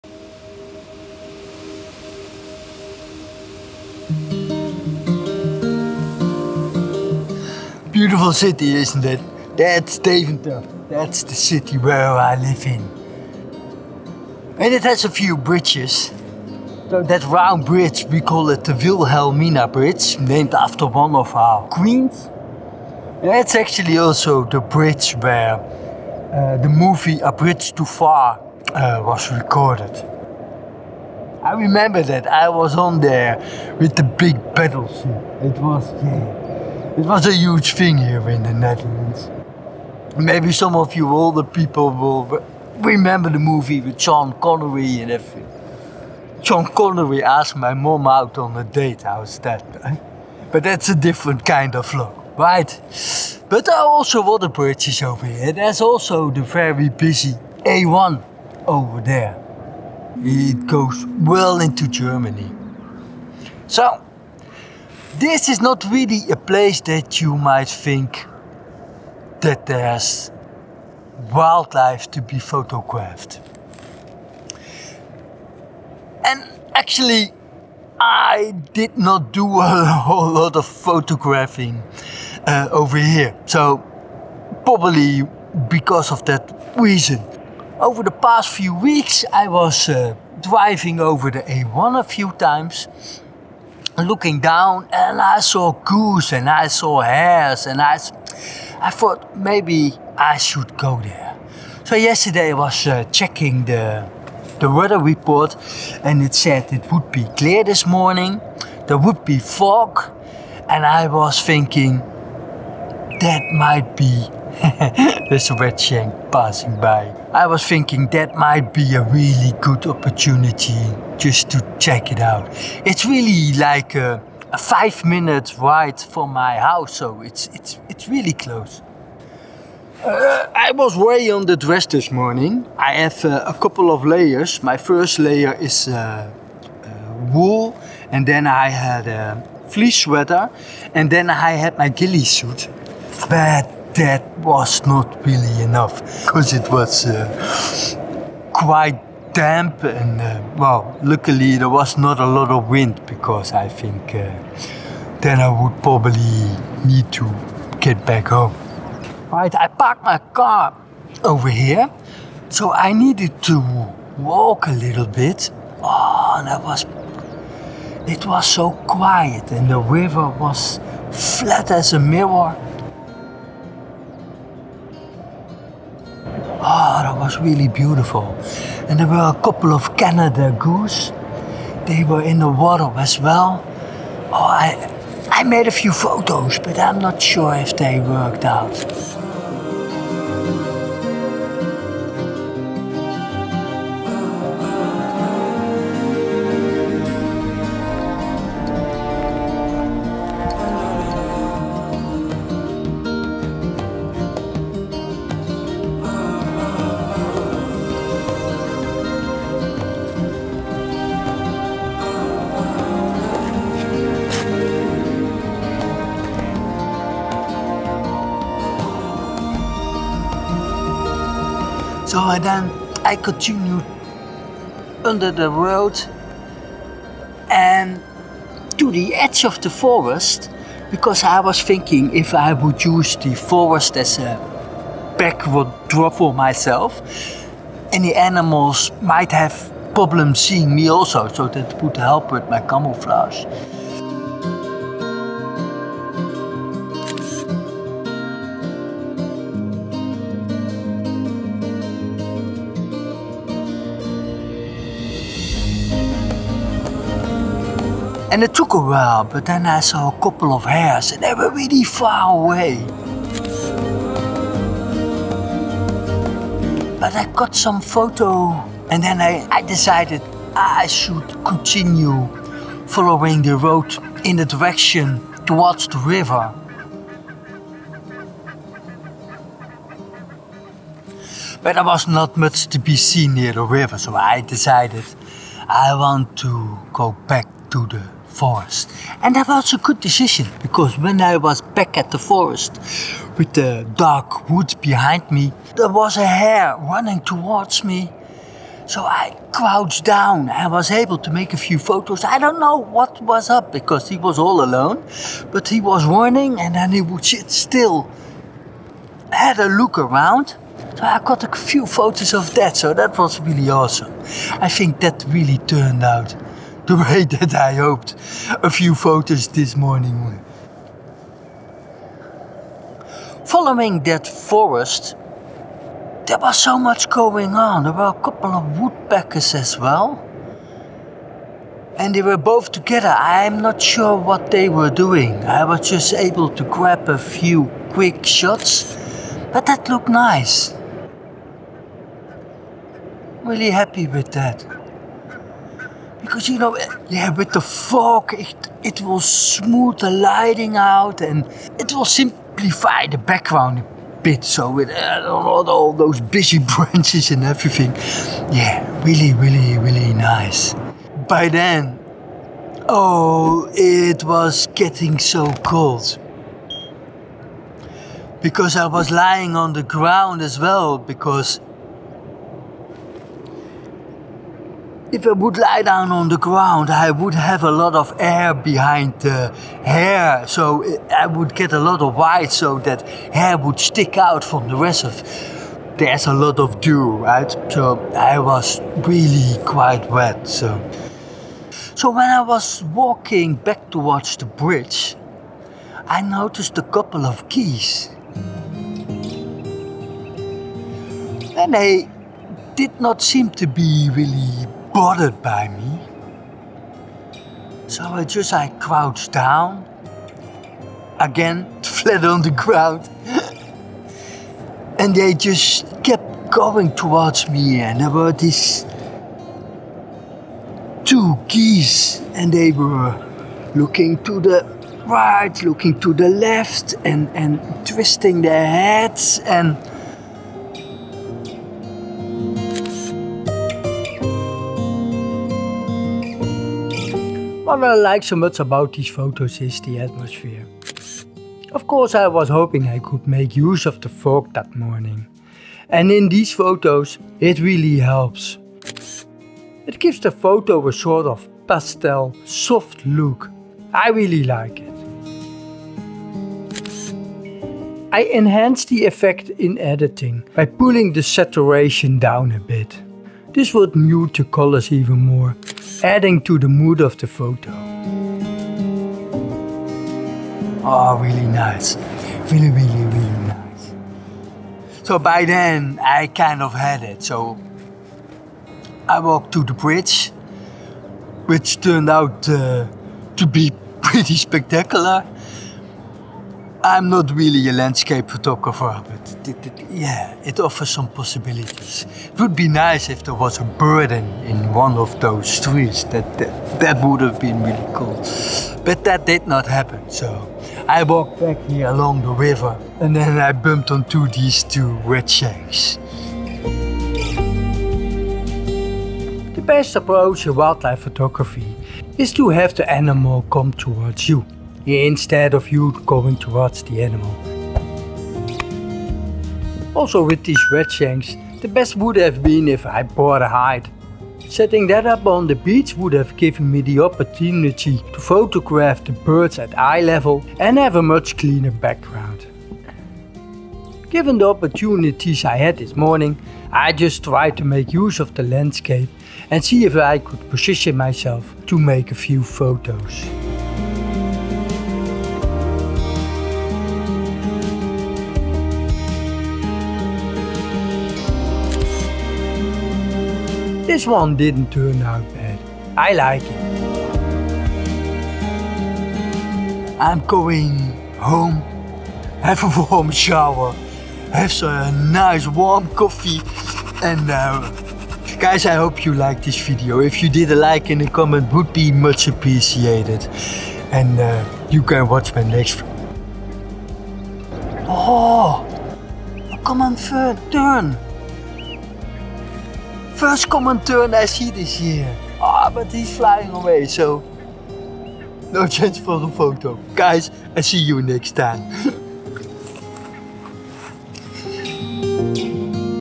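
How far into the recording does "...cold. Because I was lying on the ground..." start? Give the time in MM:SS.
06:05.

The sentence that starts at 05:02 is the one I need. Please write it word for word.
I don't know what was up because he was all alone, but he was running and then he would sit still.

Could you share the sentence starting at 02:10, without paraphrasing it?
Uh, I was way on the dress this morning.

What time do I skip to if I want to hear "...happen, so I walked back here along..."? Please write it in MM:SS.
08:19.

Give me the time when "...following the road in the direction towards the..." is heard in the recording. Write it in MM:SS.
04:32.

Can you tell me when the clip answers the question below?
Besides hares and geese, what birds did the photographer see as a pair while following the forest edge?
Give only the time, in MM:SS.
05:28.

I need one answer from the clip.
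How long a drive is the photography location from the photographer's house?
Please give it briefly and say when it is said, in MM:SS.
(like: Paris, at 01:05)
5 minutes, at 02:04.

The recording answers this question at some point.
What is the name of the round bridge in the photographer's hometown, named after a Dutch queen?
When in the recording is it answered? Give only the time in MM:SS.
00:18.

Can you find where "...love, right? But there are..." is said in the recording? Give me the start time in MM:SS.
00:51.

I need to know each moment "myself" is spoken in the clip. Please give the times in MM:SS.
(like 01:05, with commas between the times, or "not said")
03:56, 09:00.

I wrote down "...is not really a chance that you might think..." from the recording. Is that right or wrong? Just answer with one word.
wrong.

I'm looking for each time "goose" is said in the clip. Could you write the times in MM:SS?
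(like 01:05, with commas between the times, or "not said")
01:35, 03:00.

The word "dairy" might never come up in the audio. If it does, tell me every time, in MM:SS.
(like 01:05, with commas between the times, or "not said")
not said.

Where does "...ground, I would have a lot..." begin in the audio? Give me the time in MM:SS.
06:16.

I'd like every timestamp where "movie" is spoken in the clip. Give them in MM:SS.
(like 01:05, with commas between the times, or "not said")
00:26, 00:43.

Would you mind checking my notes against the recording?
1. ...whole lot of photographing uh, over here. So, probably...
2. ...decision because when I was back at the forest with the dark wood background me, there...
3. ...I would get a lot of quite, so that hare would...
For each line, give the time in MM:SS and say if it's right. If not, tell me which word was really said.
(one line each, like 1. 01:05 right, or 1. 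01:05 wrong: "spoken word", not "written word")
1. 01:20 right
2. 04:49 wrong: "behind", not "background"
3. 06:21 wrong: "white", not "quite".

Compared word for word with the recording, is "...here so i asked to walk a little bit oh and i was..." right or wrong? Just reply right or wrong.
wrong.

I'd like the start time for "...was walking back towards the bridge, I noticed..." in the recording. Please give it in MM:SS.
06:32.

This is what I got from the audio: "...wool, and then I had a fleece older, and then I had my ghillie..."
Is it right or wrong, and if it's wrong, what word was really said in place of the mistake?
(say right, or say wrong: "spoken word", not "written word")
wrong: "sweater", not "older".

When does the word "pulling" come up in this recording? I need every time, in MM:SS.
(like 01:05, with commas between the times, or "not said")
07:40.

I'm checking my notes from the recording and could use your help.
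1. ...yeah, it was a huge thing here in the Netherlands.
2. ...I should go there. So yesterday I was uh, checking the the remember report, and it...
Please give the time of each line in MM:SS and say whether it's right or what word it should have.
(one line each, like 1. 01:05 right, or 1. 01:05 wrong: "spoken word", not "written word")
1. 00:36 right
2. 01:40 wrong: "weather", not "remember".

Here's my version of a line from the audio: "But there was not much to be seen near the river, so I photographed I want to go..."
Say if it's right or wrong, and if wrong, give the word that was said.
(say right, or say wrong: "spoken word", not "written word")
wrong: "decided", not "photographed".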